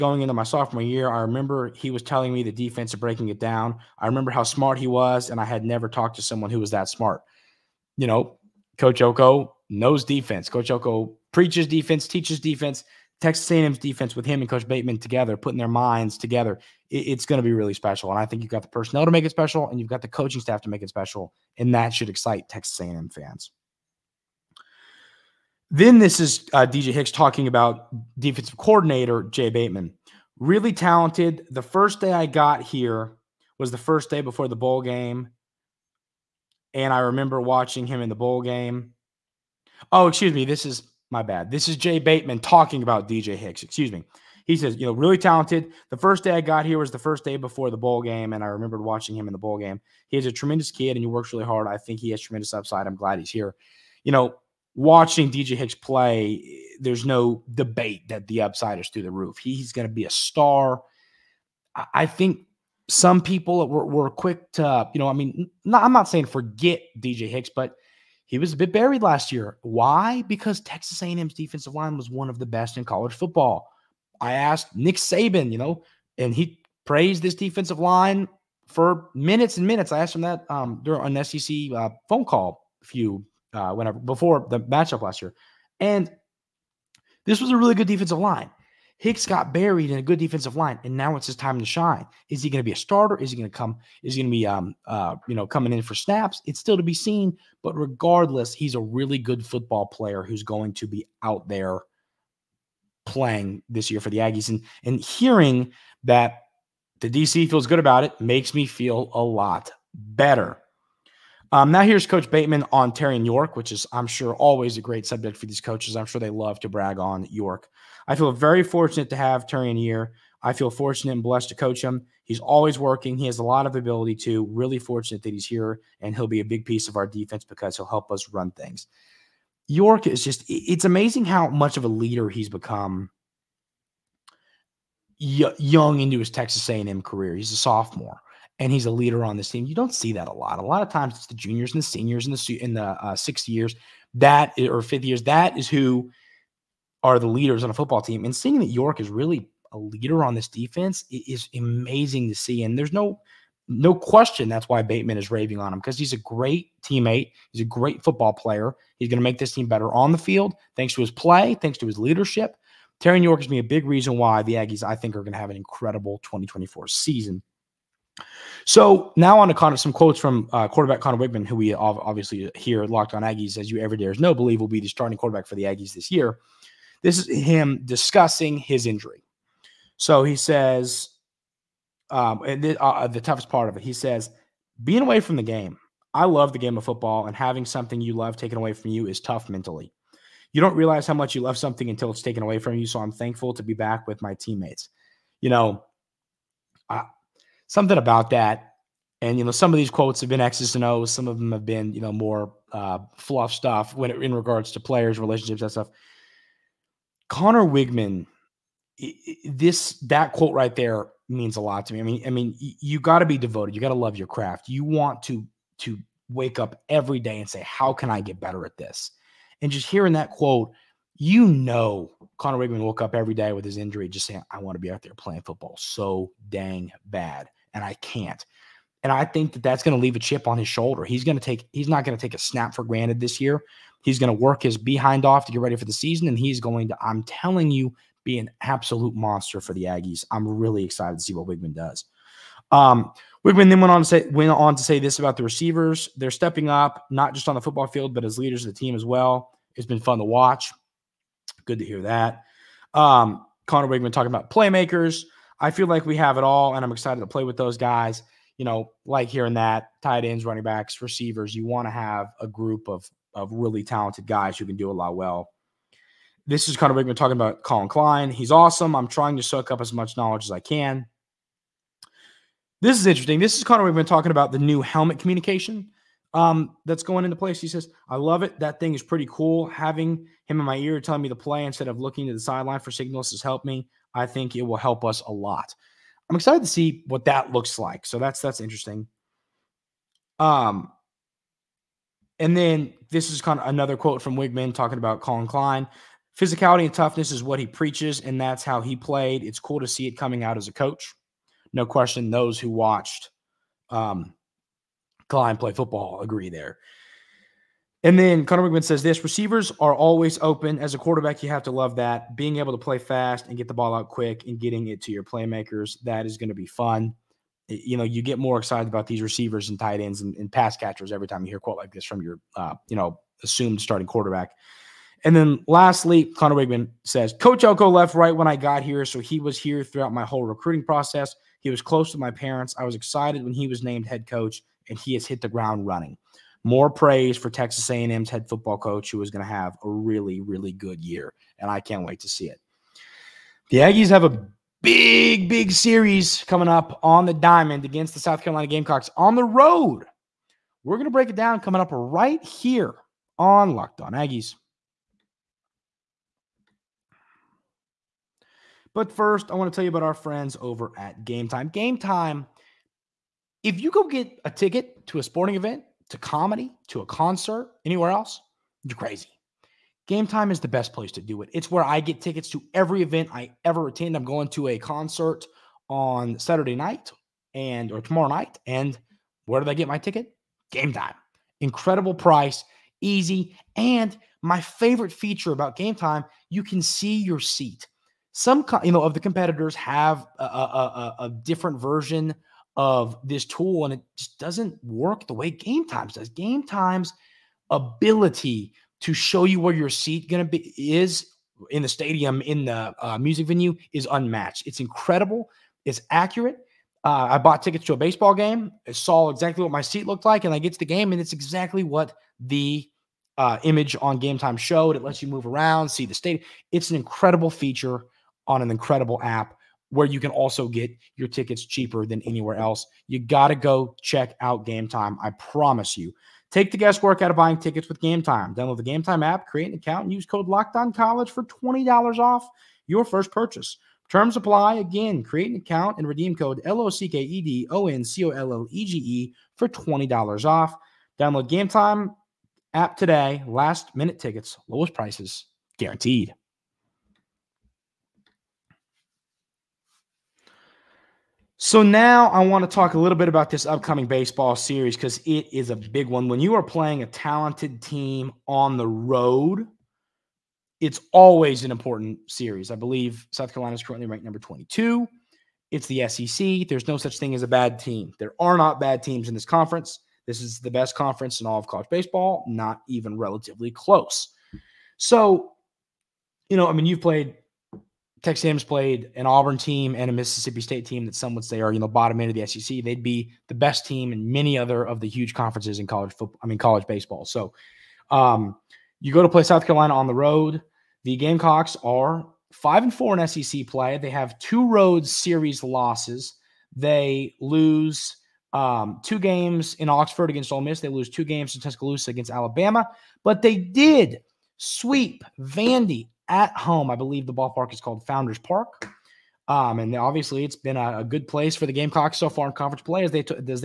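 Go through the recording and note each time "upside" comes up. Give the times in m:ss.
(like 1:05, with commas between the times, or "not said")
0:52, 0:58.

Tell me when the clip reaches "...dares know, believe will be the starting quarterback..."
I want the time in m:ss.
2:53.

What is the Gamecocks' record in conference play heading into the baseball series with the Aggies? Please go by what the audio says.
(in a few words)
5-4.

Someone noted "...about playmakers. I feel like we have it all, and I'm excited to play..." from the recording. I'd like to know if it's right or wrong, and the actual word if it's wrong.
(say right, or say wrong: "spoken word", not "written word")
right.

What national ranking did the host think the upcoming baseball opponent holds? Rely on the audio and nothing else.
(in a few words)
22.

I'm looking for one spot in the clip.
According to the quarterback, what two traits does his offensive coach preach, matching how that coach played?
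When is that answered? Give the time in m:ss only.
4:56.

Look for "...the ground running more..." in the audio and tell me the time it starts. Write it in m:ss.
5:35.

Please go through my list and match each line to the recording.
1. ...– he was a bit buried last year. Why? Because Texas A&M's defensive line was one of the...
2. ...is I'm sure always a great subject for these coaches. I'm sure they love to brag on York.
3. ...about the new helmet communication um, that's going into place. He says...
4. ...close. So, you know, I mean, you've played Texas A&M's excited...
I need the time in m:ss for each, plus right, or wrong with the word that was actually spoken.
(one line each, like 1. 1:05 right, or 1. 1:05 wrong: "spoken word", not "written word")
1. 1:07 right
2. 1:53 right
3. 4:34 right
4. 7:53 wrong: "played", not "excited".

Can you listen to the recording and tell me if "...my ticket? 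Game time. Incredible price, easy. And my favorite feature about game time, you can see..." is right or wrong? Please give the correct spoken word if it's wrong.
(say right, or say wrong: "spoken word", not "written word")
right.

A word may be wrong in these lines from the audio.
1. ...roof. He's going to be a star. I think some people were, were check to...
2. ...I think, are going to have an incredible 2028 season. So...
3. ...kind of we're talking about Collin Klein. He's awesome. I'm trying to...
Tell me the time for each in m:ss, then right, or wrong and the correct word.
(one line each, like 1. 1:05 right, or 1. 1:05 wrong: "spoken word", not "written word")
1. 0:59 wrong: "quick", not "check"
2. 2:44 wrong: "2024", not "2028"
3. 4:26 right.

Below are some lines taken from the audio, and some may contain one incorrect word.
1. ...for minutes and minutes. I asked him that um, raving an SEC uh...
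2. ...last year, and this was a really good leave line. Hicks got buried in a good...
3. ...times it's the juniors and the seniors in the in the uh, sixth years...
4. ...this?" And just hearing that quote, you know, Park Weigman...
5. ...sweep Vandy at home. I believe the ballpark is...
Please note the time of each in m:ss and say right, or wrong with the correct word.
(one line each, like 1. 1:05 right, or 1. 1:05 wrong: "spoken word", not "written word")
1. 1:18 wrong: "during", not "raving"
2. 1:25 wrong: "defensive", not "leave"
3. 2:20 right
4. 3:38 wrong: "Conner", not "Park"
5. 8:24 right.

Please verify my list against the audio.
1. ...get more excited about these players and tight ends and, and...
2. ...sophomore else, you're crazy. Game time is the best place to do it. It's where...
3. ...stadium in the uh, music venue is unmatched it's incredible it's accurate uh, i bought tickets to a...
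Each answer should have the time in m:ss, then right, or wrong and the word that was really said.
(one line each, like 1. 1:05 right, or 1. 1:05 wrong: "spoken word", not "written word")
1. 5:18 wrong: "receivers", not "players"
2. 6:07 wrong: "anywhere", not "sophomore"
3. 6:41 right.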